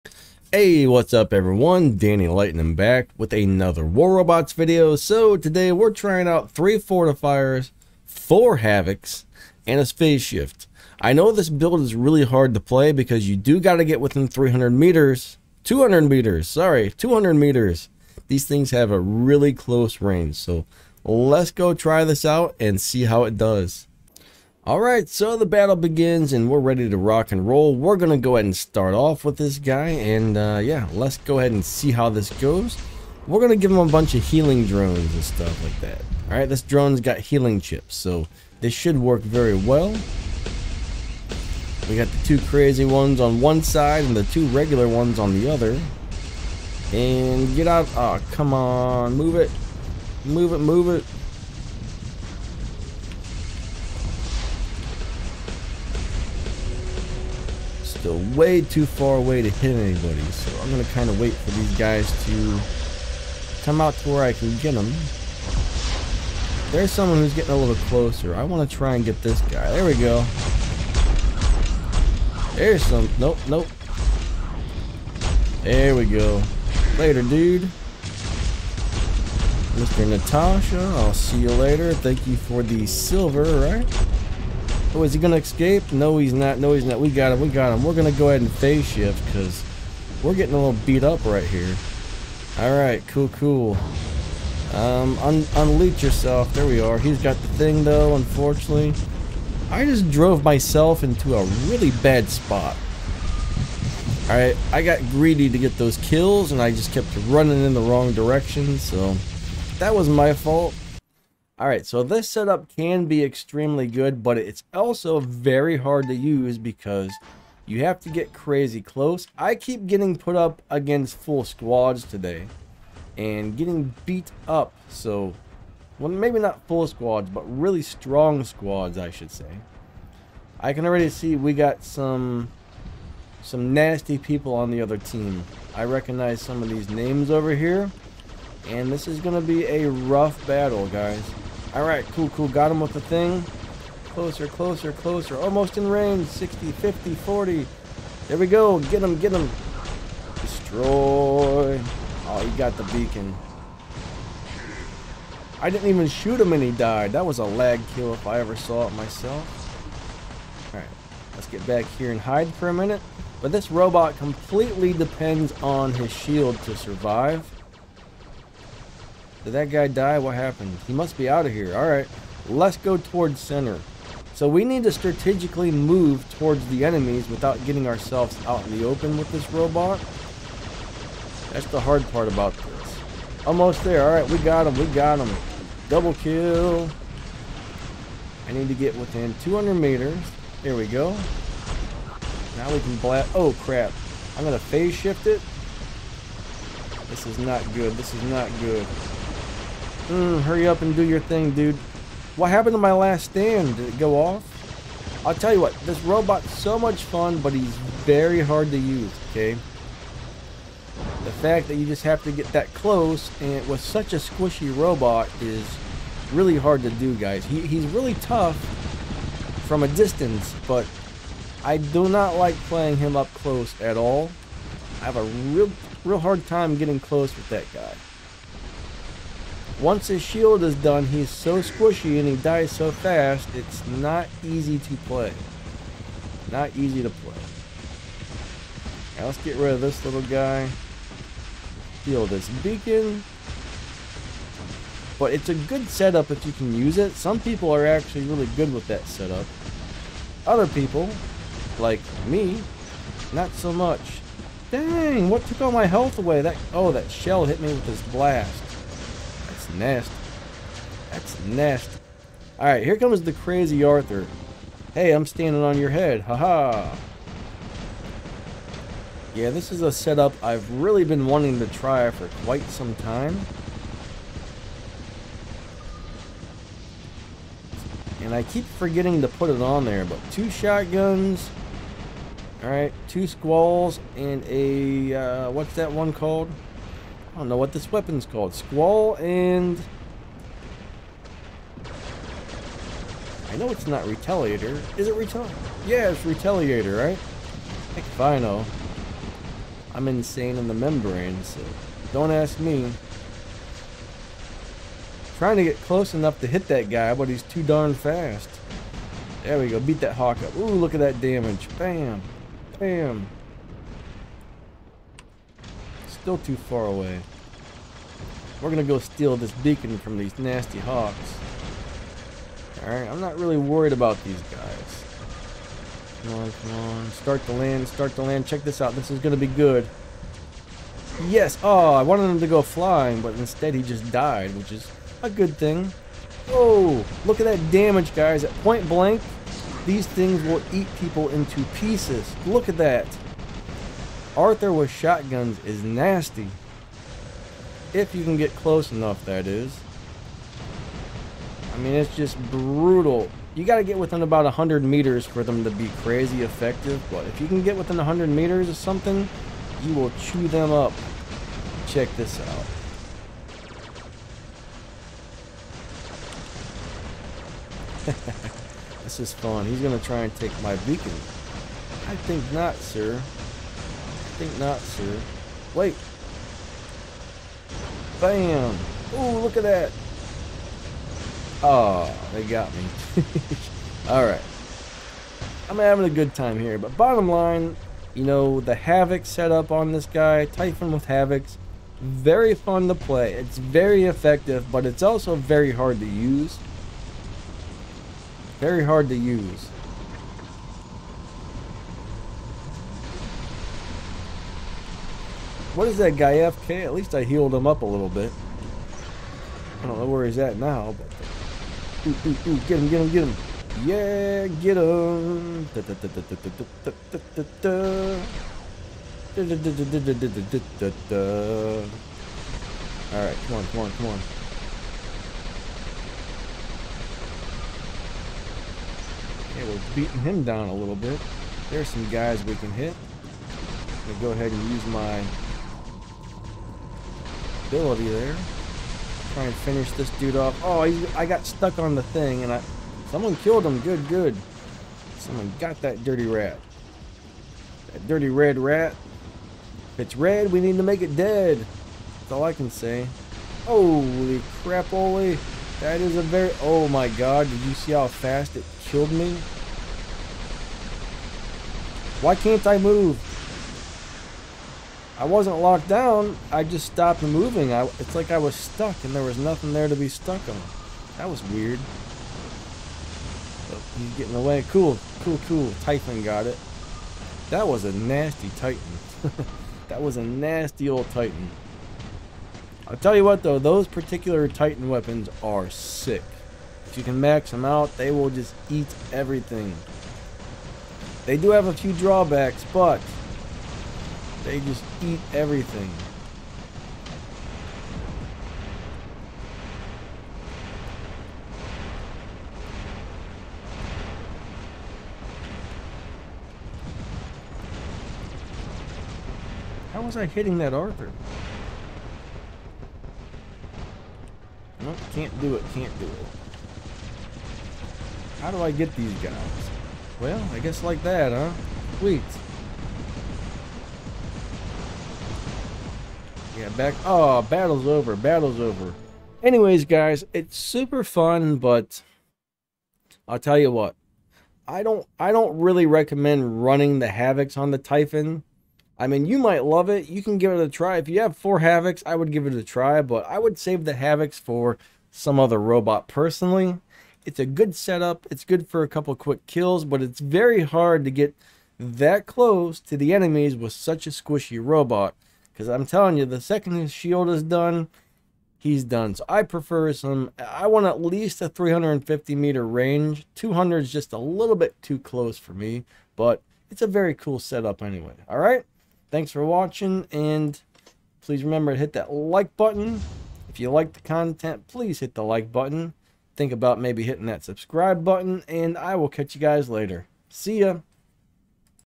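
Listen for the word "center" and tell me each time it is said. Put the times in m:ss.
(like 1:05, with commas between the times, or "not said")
2:53.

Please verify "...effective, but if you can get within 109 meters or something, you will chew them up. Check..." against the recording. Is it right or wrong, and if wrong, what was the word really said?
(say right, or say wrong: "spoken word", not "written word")
wrong: "100", not "109".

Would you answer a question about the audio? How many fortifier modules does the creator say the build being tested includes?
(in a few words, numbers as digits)
3.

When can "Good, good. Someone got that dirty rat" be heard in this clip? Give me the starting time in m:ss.
7:23.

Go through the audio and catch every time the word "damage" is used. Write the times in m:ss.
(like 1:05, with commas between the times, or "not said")
5:11, 5:37.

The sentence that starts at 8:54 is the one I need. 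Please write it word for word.
I don't I don't really recommend running the Havocs on the Typhon.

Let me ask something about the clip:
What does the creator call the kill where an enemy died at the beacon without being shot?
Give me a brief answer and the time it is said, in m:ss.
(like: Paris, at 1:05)
A lag kill, at 2:37.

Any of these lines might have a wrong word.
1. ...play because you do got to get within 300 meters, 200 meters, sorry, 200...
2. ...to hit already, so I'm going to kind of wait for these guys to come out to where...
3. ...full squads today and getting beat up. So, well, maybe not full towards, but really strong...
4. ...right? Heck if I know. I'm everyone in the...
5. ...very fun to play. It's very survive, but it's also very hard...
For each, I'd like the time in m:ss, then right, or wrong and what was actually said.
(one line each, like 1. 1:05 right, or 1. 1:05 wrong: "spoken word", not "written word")
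1. 0:12 right
2. 0:59 wrong: "anybody", not "already"
3. 2:01 wrong: "squads", not "towards"
4. 4:56 wrong: "insane", not "everyone"
5. 6:32 wrong: "effective", not "survive".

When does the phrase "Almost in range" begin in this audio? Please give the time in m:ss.
2:25.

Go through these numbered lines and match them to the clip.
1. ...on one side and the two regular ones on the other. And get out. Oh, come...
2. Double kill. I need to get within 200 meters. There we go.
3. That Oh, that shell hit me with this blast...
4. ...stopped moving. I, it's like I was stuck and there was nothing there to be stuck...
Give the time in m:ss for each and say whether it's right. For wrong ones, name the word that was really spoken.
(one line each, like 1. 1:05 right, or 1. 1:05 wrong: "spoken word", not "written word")
1. 0:43 right
2. 3:05 right
3. 4:16 right
4. 7:46 right.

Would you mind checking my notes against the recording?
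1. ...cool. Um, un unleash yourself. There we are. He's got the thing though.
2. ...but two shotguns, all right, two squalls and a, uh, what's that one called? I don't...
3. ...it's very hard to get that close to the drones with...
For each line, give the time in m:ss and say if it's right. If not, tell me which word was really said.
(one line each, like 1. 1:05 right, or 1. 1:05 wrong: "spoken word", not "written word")
1. 1:33 right
2. 4:40 right
3. 9:10 wrong: "enemies", not "drones".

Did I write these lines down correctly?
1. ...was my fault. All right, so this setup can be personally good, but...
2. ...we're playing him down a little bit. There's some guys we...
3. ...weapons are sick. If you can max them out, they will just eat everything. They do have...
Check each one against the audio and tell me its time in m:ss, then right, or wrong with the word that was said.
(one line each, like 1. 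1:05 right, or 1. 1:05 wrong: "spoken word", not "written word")
1. 1:49 wrong: "extremely", not "personally"
2. 7:09 wrong: "beating", not "playing"
3. 8:04 right.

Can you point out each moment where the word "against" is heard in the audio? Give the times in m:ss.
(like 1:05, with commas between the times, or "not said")
2:00.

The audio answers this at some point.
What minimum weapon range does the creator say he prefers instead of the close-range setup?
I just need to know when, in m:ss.
9:21.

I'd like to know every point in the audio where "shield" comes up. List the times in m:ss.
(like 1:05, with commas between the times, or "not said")
2:46, 3:50, 9:16.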